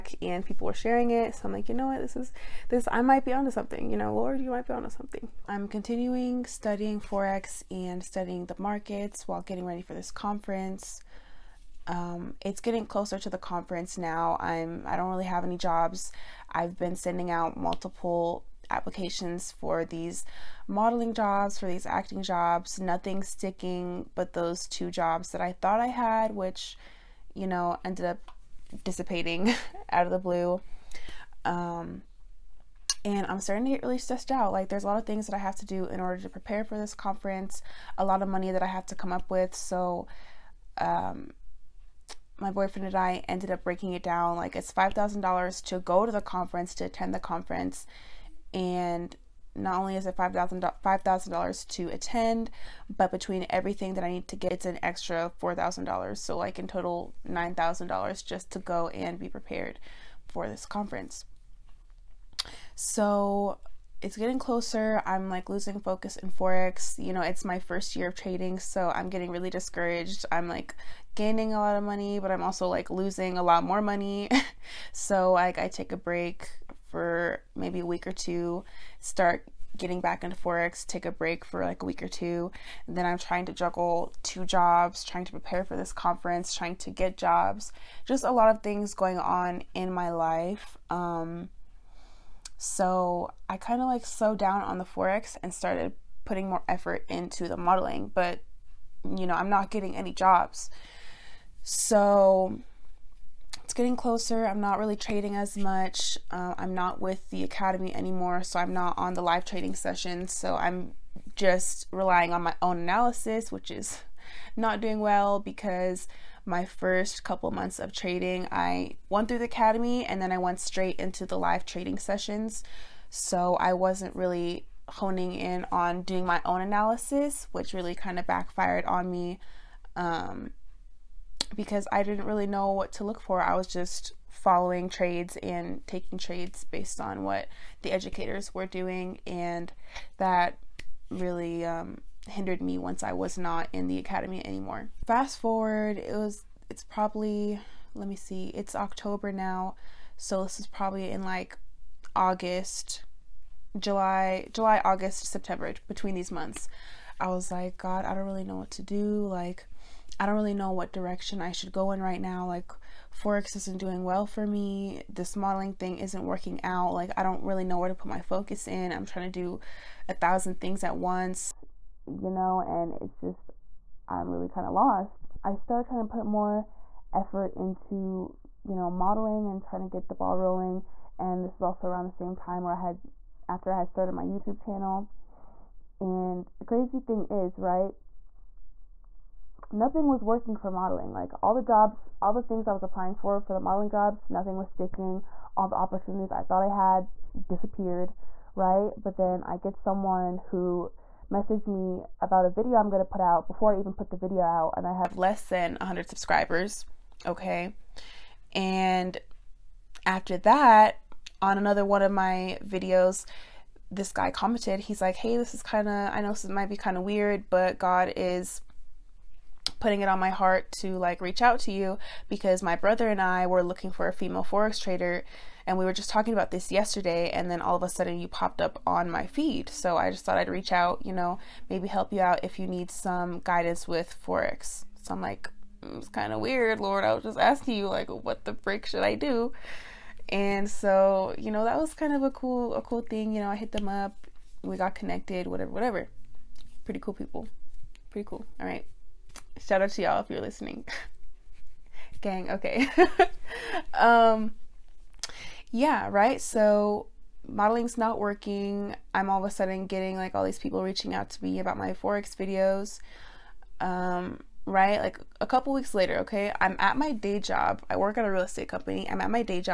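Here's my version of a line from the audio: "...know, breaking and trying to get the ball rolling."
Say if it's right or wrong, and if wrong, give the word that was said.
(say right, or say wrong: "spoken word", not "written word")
wrong: "modeling", not "breaking".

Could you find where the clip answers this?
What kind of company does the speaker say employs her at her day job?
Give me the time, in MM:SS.
04:28.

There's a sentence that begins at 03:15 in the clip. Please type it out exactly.
All the opportunities I thought I had disappeared, right?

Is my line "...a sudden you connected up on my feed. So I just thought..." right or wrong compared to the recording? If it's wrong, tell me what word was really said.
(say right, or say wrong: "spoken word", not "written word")
wrong: "popped", not "connected".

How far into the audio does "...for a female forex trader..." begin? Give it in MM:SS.
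03:43.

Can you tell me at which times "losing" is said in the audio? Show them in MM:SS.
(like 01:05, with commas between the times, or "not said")
01:05, 01:12.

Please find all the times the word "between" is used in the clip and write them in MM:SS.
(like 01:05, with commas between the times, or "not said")
00:53, 02:35.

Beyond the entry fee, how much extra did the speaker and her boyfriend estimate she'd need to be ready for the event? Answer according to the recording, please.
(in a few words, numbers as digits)
$4,000.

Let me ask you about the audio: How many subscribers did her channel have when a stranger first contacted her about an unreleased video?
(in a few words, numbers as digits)
less than 100.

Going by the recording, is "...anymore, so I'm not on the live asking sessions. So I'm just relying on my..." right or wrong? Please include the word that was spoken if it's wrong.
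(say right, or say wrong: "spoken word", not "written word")
wrong: "trading", not "asking".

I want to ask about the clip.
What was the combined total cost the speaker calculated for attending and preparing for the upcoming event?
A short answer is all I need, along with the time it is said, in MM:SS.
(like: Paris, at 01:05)
$9,000, at 00:57.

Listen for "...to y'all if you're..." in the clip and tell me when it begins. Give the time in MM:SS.
04:09.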